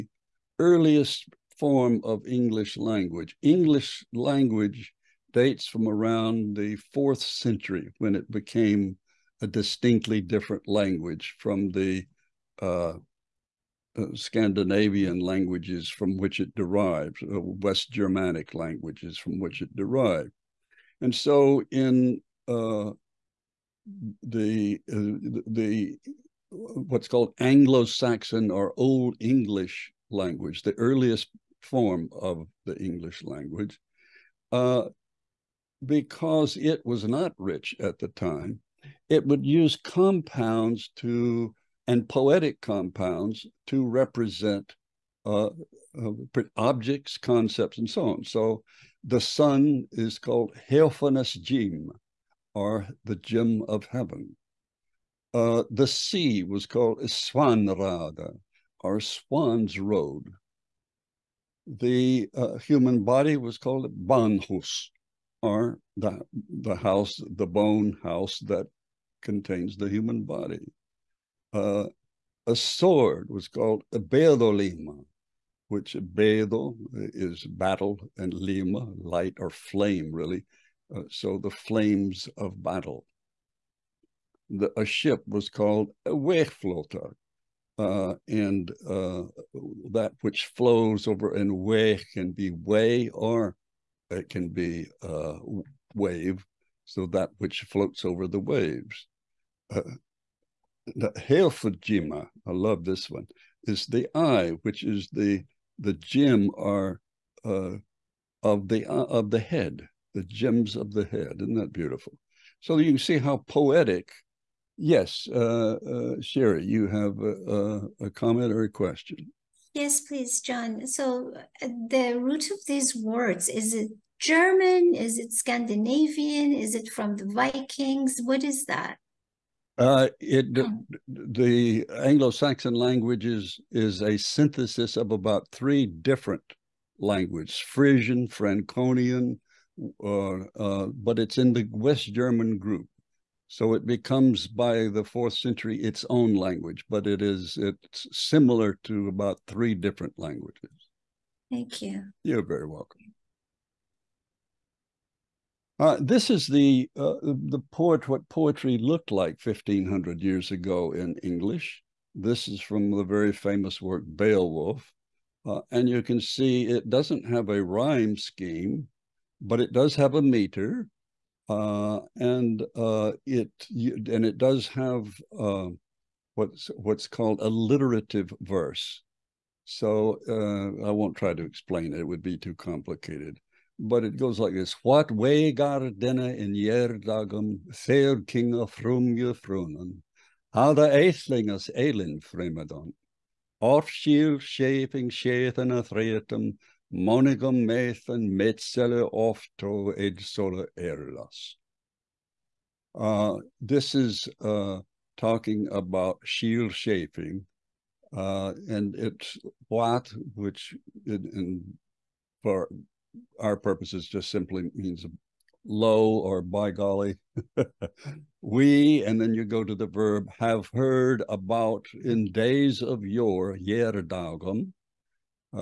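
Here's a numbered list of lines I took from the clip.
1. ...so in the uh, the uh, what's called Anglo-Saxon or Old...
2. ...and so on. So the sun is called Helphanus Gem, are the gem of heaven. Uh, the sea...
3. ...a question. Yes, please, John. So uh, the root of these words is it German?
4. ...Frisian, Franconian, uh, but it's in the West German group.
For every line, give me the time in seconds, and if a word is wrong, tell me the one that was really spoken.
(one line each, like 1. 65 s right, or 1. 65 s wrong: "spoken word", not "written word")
1. 21 s right
2. 47 s right
3. 118 s right
4. 137 s right.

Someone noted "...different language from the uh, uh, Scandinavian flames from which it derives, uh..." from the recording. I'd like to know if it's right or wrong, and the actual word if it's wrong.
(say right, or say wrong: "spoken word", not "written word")
wrong: "languages", not "flames".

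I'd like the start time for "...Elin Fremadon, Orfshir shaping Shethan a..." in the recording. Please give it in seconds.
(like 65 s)
191 s.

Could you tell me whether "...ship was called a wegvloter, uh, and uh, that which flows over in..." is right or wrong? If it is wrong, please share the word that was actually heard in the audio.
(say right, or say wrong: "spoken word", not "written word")
right.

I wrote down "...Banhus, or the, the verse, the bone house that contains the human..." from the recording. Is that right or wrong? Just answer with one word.
wrong.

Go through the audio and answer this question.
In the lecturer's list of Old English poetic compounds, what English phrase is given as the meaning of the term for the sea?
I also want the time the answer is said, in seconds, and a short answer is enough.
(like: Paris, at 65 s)
Swan's Road, at 59 s.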